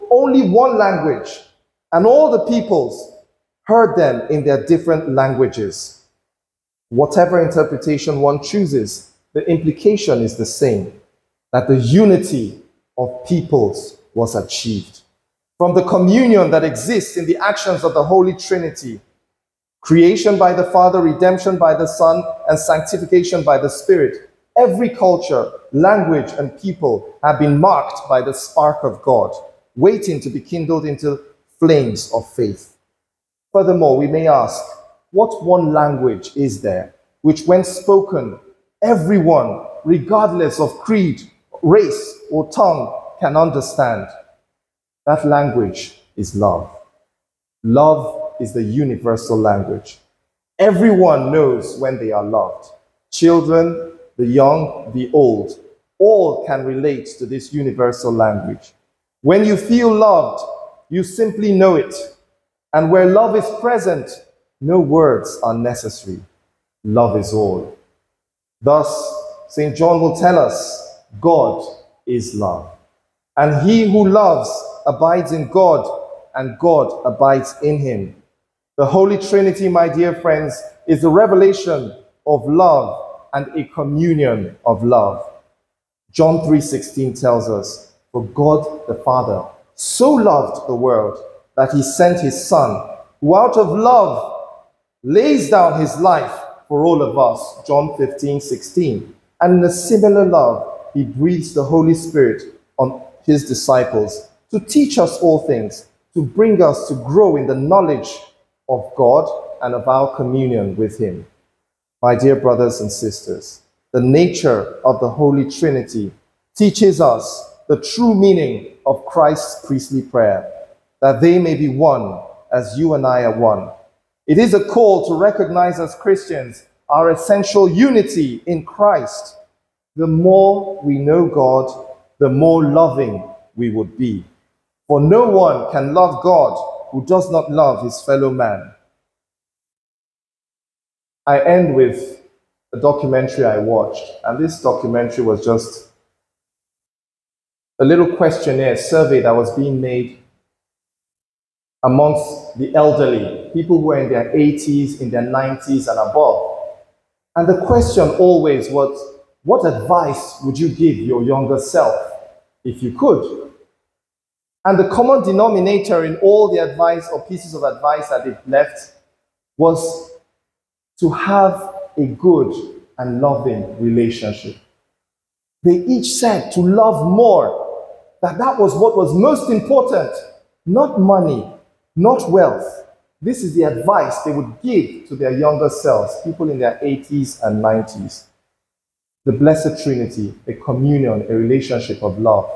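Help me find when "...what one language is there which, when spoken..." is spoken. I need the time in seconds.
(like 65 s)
35 s.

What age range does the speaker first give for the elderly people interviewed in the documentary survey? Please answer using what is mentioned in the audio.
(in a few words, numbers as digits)
80s and 90s.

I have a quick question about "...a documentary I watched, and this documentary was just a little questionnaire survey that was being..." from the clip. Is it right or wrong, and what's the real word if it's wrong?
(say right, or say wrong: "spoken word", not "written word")
right.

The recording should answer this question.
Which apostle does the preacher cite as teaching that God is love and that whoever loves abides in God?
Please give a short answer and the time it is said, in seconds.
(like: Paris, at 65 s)
St. John, at 69 s.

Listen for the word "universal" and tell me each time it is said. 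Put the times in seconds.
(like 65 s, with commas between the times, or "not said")
48 s, 57 s.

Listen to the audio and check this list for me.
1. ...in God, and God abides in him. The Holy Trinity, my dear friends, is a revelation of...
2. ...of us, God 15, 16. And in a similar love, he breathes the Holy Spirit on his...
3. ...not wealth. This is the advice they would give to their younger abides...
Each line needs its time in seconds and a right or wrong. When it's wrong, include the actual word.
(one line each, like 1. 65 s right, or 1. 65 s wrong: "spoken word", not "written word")
1. 75 s right
2. 97 s wrong: "John", not "God"
3. 181 s wrong: "selves", not "abides".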